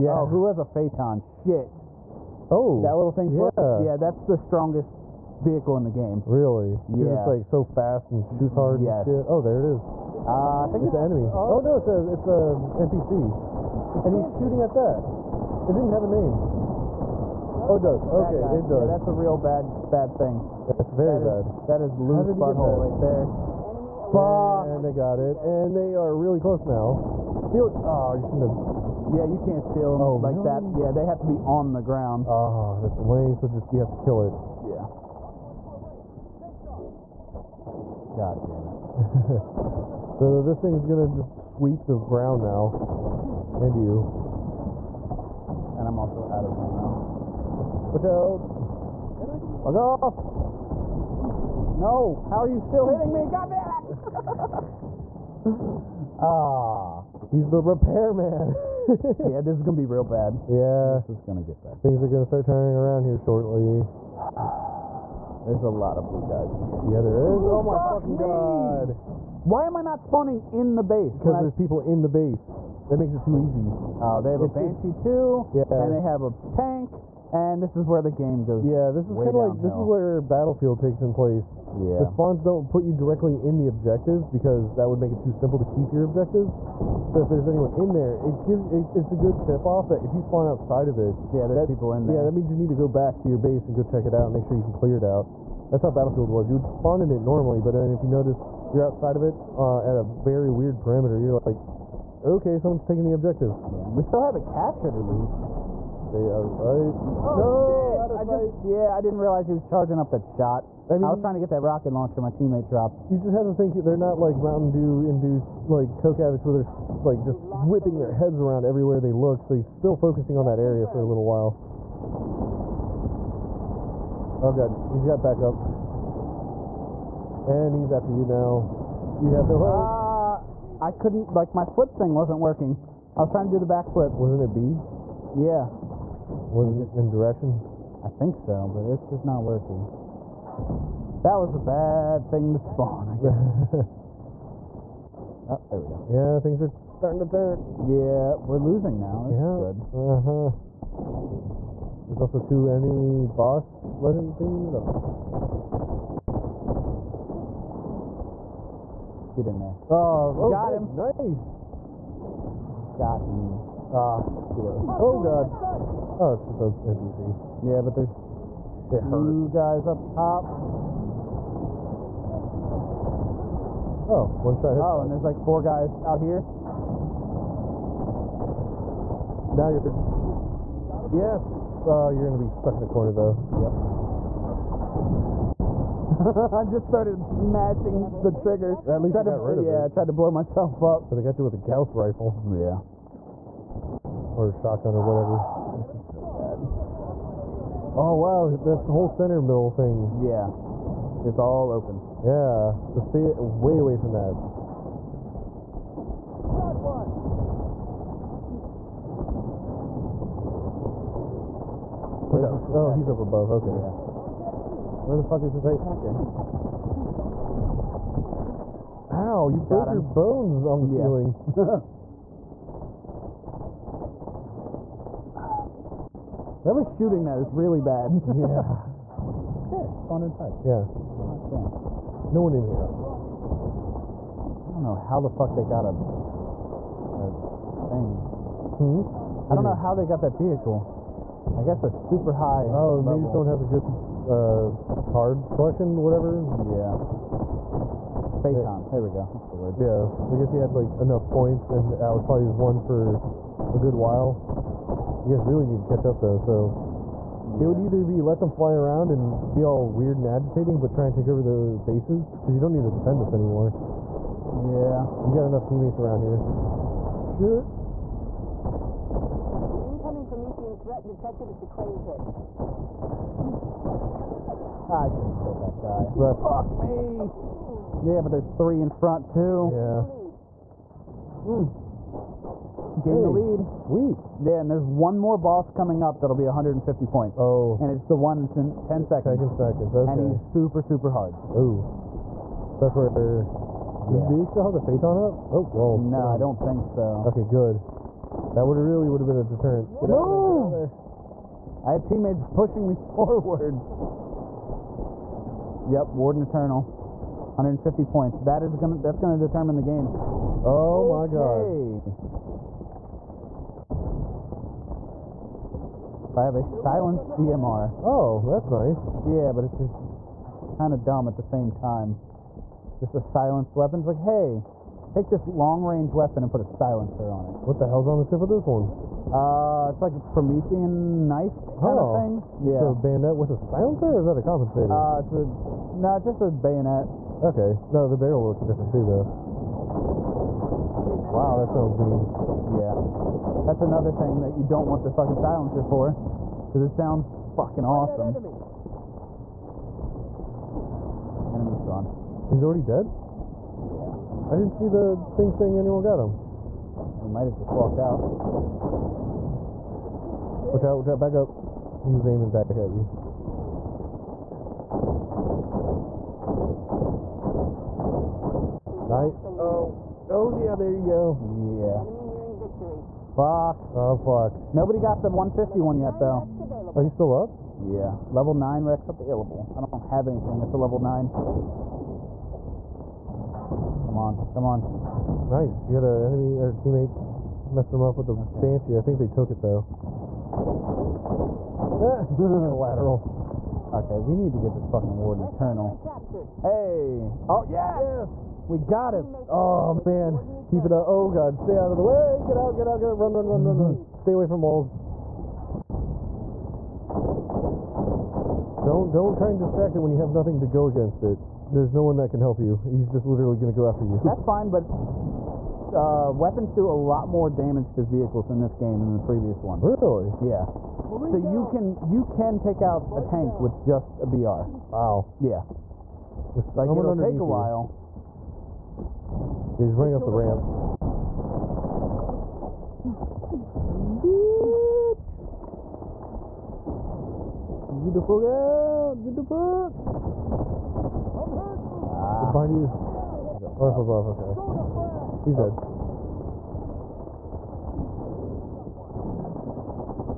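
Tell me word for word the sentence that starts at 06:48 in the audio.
Don't don't try and distract it when you have nothing to go against it.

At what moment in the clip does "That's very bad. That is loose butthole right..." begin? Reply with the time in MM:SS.
00:20.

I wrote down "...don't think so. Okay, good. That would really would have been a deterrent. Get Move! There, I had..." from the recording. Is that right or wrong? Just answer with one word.
right.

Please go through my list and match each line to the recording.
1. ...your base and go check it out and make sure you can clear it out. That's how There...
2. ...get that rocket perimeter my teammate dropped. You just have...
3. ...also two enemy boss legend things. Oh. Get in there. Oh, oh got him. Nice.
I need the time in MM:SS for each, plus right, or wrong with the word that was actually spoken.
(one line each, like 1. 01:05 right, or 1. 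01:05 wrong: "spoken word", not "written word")
1. 01:33 wrong: "Battlefield", not "There"
2. 01:51 wrong: "launcher", not "perimeter"
3. 02:32 right.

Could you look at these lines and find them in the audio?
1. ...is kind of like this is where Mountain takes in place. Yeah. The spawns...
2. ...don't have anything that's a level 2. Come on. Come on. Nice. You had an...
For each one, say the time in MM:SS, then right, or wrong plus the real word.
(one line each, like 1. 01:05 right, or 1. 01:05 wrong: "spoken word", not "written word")
1. 01:19 wrong: "Battlefield", not "Mountain"
2. 06:19 wrong: "9", not "2".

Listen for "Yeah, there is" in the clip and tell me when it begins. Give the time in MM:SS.
01:06.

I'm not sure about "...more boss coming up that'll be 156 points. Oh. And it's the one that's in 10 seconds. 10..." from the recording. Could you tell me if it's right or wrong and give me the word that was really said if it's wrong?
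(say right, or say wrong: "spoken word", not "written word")
wrong: "150", not "156".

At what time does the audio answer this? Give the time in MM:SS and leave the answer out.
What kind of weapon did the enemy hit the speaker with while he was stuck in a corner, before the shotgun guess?
03:11.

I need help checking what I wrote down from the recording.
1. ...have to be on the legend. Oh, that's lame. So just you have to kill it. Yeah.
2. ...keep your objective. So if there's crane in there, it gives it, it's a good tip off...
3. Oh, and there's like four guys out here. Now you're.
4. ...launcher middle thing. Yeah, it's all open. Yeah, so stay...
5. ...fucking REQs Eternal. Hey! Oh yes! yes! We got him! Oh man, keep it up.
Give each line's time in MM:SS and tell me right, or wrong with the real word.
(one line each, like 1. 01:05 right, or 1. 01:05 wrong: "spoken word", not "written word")
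1. 00:31 wrong: "ground", not "legend"
2. 01:25 wrong: "anyone", not "crane"
3. 02:54 right
4. 03:19 wrong: "center", not "launcher"
5. 06:34 wrong: "Warden", not "REQs".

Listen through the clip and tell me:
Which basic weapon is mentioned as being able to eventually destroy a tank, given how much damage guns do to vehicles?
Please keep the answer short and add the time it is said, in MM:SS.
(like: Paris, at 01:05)
BR, at 07:04.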